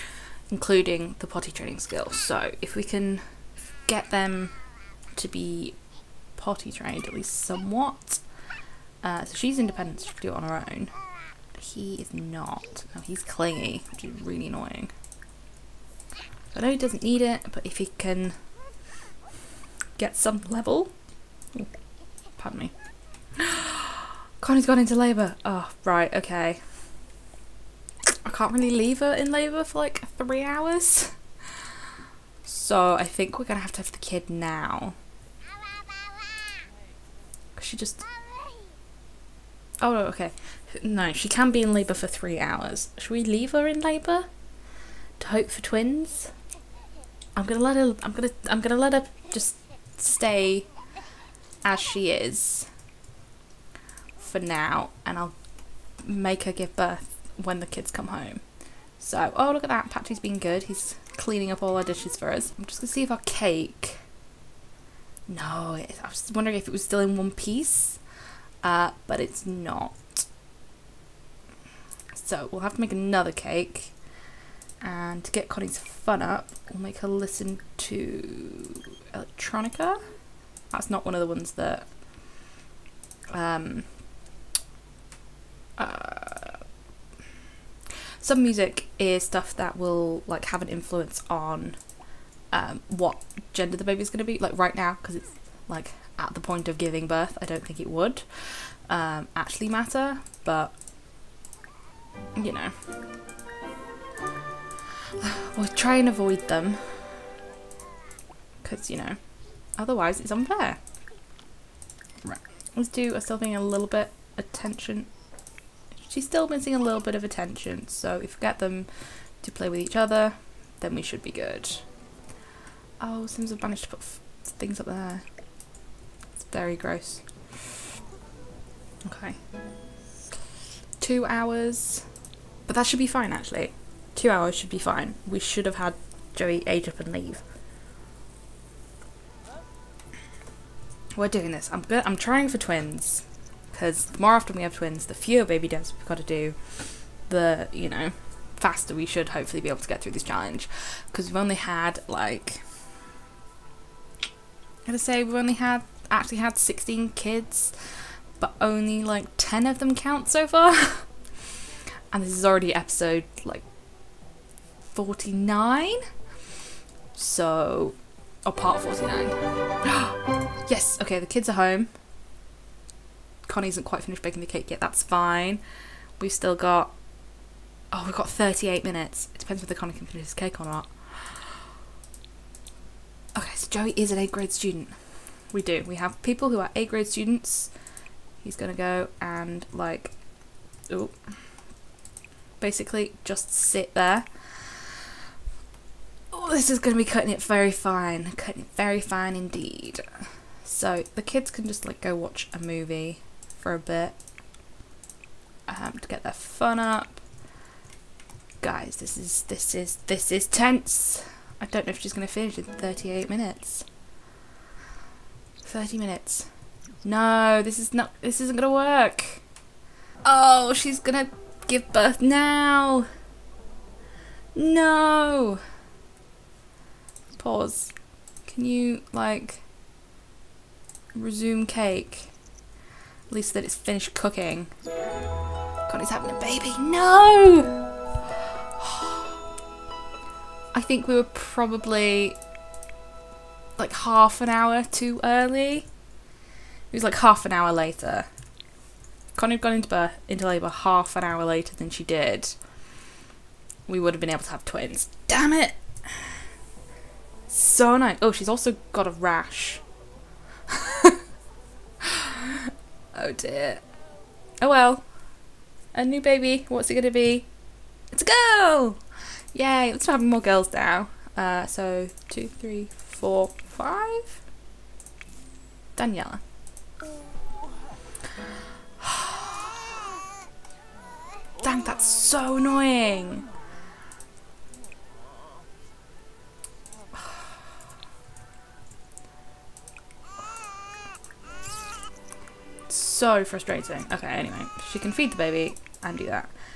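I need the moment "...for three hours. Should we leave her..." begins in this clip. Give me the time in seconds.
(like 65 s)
41 s.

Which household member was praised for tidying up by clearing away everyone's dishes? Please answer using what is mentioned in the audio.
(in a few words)
Patrick.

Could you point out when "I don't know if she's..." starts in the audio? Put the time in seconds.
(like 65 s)
211 s.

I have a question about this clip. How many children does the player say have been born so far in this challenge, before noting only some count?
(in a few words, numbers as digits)
16.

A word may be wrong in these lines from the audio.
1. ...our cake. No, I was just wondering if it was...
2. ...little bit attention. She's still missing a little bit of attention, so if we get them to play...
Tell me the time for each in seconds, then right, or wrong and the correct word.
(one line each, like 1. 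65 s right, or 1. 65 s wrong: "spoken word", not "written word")
1. 63 s right
2. 113 s right.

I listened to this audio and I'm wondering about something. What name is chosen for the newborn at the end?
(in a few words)
Daniella.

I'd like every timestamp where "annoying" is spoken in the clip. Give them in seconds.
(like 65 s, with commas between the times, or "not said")
14 s, 282 s.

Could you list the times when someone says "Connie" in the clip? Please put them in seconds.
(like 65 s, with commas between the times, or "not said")
24 s, 75 s, 173 s, 179 s, 249 s.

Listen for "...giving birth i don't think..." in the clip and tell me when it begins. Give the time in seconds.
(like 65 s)
96 s.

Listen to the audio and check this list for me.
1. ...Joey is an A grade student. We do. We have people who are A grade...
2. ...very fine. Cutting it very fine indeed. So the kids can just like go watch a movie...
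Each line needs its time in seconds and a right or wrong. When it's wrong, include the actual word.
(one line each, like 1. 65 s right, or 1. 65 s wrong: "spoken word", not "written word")
1. 183 s right
2. 197 s right.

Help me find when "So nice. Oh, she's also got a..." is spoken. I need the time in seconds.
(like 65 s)
257 s.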